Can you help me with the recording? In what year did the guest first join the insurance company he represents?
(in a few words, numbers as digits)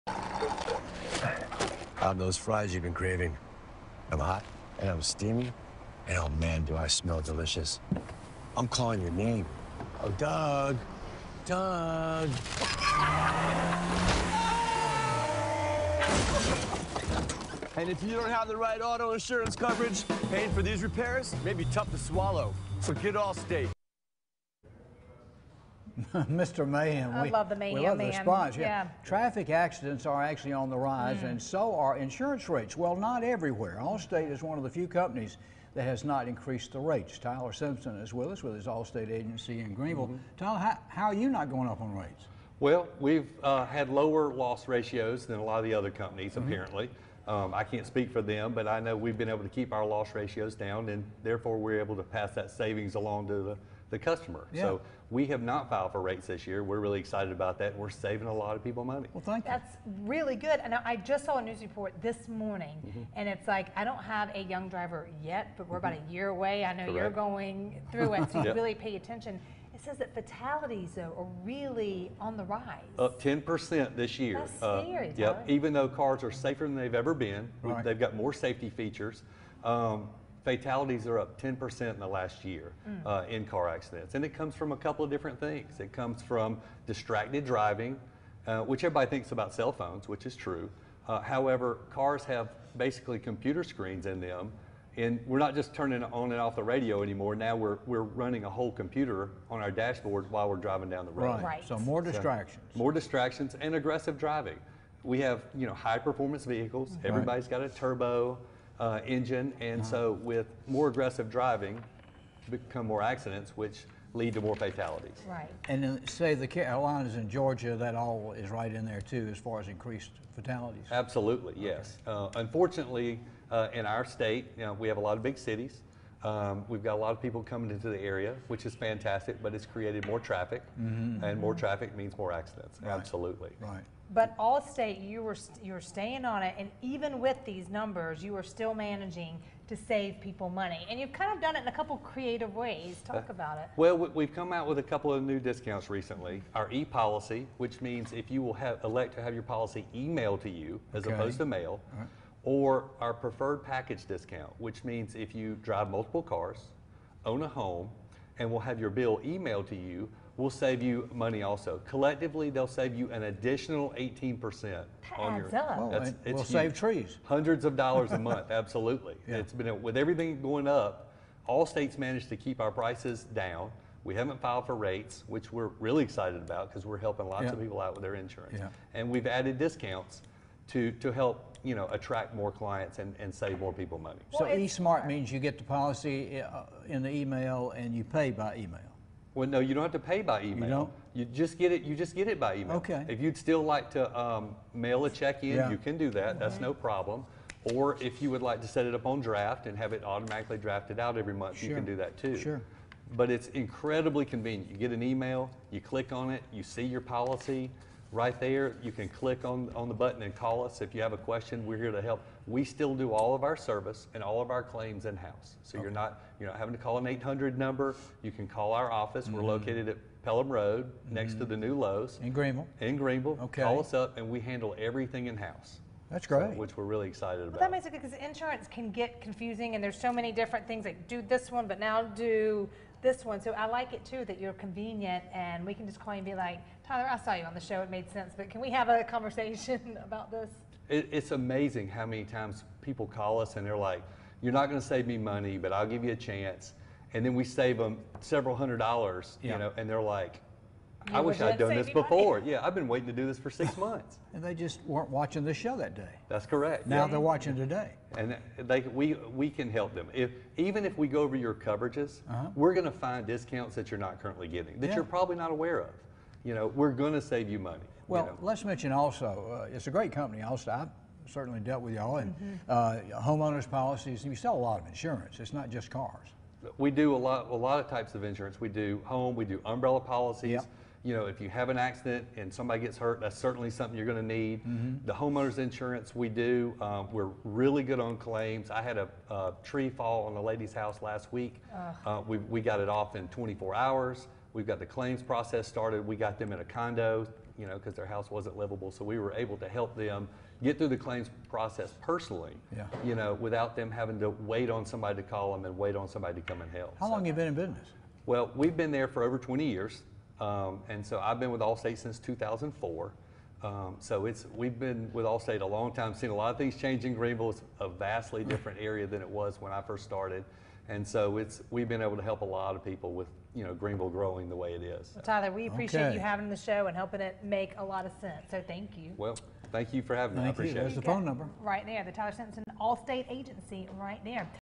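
2004.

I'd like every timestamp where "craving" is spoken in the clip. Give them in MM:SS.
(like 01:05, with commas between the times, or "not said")
00:02.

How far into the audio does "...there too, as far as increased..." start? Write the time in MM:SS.
01:58.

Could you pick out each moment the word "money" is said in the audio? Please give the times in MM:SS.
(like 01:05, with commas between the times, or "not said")
00:58, 02:20, 02:41, 03:03, 04:05, 04:12, 04:27.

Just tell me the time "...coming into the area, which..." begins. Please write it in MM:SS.
02:07.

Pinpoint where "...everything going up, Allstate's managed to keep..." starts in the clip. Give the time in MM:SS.
02:49.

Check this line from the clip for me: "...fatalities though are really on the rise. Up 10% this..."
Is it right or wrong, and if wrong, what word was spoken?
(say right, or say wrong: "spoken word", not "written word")
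right.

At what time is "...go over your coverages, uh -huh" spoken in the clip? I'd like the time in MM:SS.
04:21.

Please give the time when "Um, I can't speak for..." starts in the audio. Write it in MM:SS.
00:47.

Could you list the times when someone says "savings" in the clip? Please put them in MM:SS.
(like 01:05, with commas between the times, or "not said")
00:52, 00:57.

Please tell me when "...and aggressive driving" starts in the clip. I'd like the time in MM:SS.
01:43.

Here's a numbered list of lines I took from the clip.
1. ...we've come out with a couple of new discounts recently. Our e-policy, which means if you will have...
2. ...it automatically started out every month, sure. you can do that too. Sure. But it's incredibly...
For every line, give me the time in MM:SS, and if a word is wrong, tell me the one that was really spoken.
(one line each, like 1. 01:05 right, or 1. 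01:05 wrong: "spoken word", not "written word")
1. 02:23 right
2. 03:19 wrong: "drafted", not "started".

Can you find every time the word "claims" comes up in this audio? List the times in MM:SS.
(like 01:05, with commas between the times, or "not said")
03:34, 04:48, 04:54, 05:01.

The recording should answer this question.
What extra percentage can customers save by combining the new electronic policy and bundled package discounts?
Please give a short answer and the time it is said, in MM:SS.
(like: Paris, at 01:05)
18%, at 02:43.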